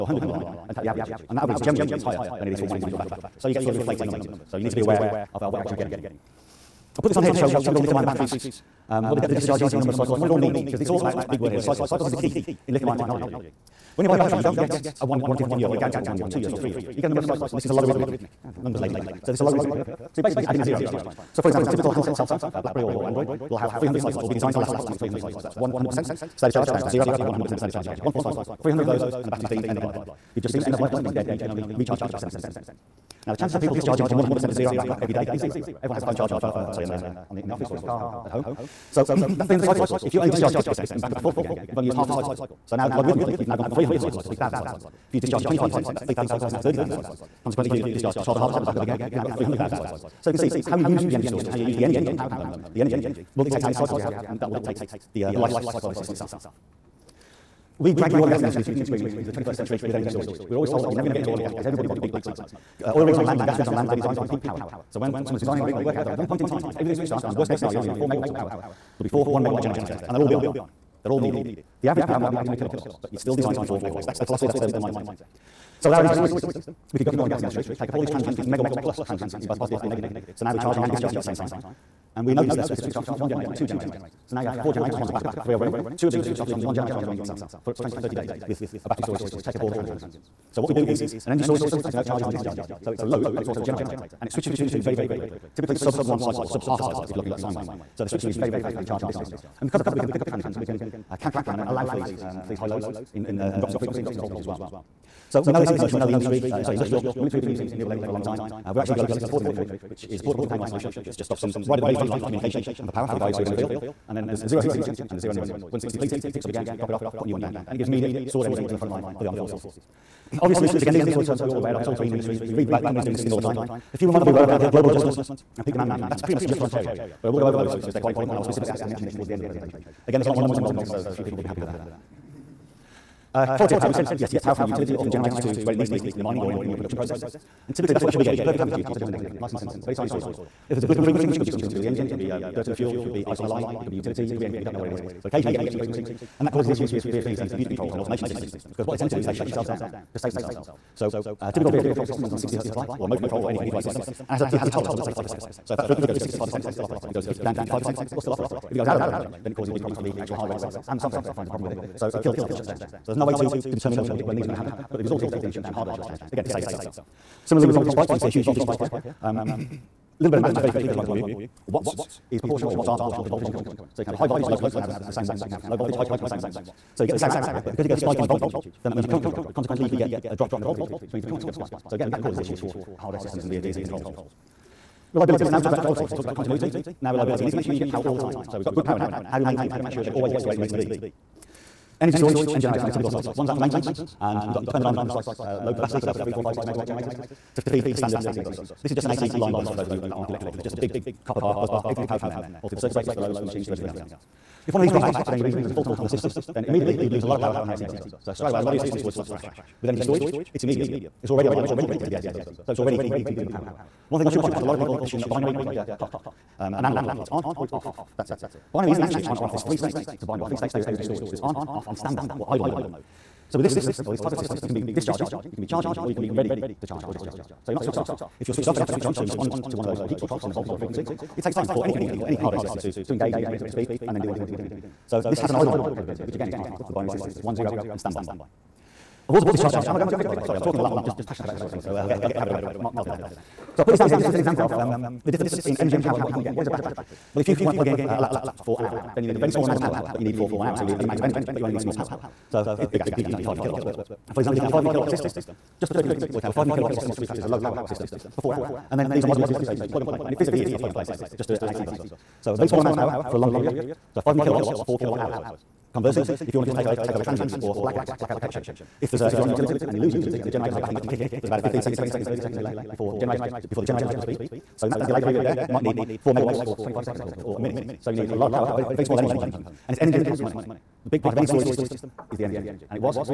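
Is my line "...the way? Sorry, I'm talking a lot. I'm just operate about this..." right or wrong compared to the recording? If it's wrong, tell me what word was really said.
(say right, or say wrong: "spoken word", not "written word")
wrong: "passionate", not "operate".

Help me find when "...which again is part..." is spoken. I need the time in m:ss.
3:56.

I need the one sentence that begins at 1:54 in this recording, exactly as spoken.
And then there's zero heat signature and there's zero noise.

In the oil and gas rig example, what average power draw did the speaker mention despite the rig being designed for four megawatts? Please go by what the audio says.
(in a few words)
800 kilowatts.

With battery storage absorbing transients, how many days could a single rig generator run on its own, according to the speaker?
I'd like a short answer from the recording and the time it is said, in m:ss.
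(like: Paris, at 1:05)
20 to 30 days, at 1:27.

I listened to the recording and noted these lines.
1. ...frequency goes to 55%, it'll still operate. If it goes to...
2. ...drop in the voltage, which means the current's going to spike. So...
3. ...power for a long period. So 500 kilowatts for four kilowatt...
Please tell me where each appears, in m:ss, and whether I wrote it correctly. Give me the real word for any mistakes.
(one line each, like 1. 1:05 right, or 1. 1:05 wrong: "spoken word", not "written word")
1. 2:35 wrong: "65", not "55"
2. 3:00 right
3. 4:22 right.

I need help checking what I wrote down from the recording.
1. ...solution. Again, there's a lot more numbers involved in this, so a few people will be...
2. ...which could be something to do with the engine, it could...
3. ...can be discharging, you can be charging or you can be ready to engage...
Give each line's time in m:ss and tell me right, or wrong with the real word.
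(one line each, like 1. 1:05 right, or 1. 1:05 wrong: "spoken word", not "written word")
1. 2:09 wrong: "presentation", not "solution"
2. 2:21 right
3. 3:44 wrong: "charge", not "engage".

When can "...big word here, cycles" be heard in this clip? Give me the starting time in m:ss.
0:11.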